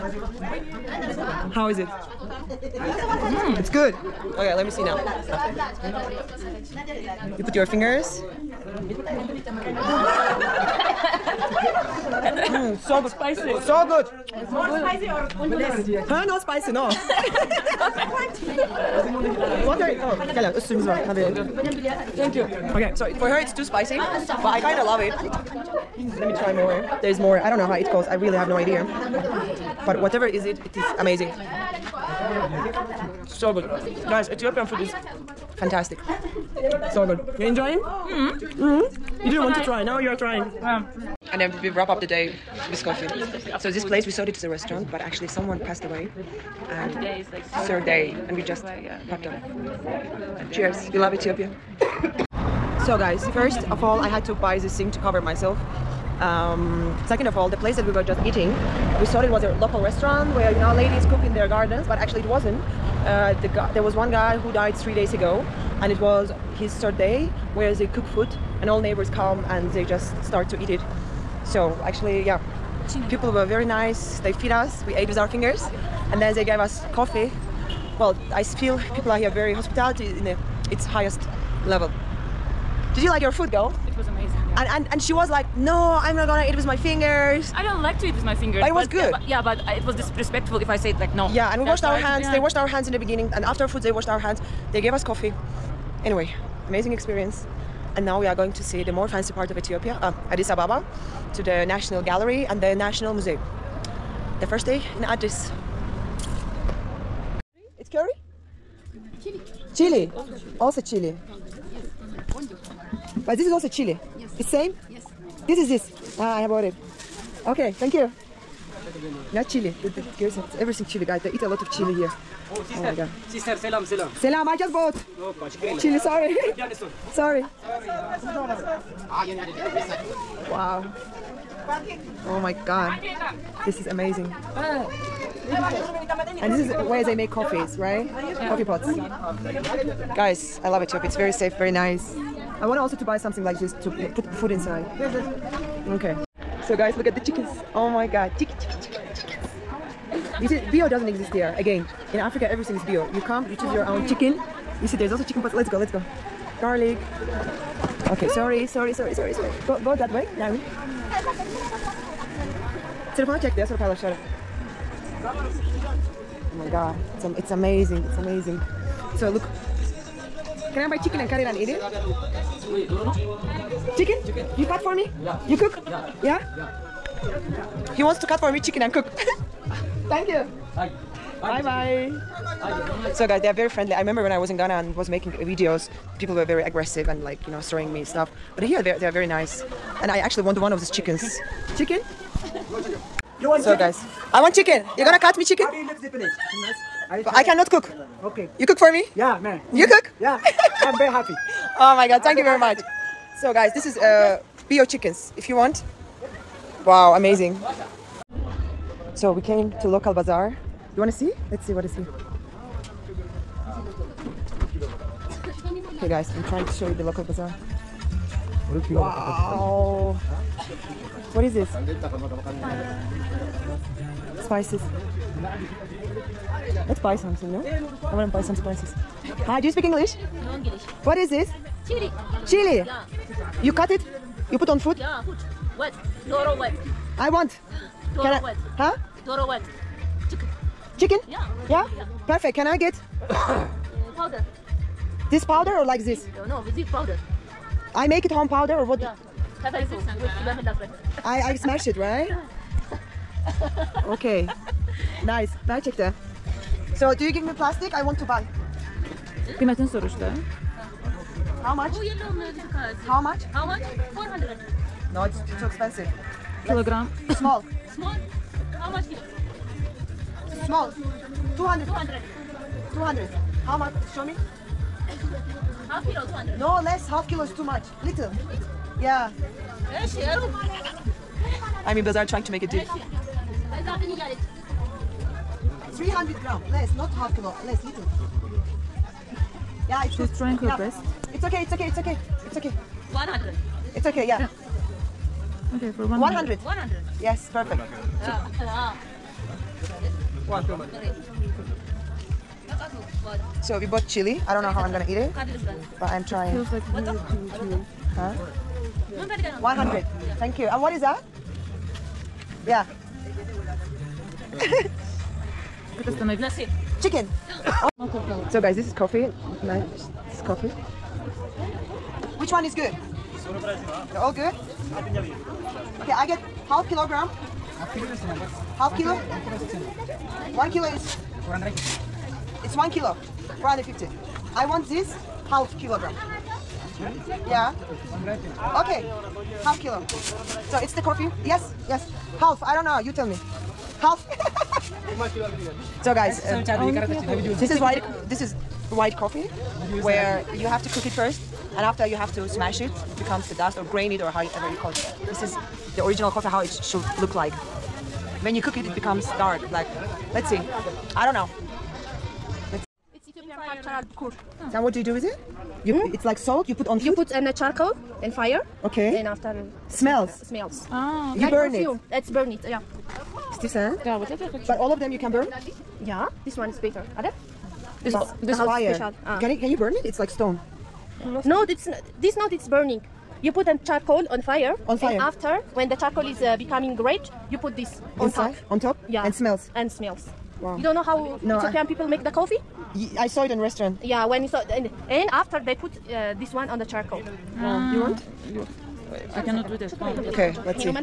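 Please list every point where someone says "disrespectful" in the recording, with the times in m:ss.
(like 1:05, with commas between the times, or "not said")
1:29.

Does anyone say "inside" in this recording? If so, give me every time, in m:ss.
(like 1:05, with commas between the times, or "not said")
2:24, 6:28.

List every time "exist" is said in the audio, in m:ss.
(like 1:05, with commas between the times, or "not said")
2:31.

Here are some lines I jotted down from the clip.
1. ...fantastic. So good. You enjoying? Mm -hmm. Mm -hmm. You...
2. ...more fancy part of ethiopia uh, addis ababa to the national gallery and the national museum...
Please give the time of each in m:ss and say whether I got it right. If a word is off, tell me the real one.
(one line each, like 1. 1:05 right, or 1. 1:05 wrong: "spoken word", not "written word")
1. 0:35 right
2. 1:38 right.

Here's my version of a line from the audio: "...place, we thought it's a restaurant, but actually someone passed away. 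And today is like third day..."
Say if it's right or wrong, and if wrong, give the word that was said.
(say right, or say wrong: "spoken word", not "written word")
right.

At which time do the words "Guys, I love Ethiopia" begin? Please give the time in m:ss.
2:20.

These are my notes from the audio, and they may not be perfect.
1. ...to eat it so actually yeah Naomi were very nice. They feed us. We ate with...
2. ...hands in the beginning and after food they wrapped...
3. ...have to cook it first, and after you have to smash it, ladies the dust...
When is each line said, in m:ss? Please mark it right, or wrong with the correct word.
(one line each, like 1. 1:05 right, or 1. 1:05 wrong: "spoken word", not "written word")
1. 1:10 wrong: "People", not "Naomi"
2. 1:32 wrong: "washed", not "wrapped"
3. 5:50 wrong: "becomes", not "ladies".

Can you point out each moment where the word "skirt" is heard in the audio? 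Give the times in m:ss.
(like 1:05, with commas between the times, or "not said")
not said.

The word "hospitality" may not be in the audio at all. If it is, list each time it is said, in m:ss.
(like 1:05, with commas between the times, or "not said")
1:19.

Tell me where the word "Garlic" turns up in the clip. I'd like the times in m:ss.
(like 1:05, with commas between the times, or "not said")
2:36.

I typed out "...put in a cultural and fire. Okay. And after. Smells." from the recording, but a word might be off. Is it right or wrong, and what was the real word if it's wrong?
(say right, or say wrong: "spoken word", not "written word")
wrong: "charcoal", not "cultural".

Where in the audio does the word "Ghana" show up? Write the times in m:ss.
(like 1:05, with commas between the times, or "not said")
3:04.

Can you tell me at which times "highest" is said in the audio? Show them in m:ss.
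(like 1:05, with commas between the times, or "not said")
1:20.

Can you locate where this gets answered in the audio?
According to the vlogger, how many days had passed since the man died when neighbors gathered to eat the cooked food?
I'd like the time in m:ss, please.
1:04.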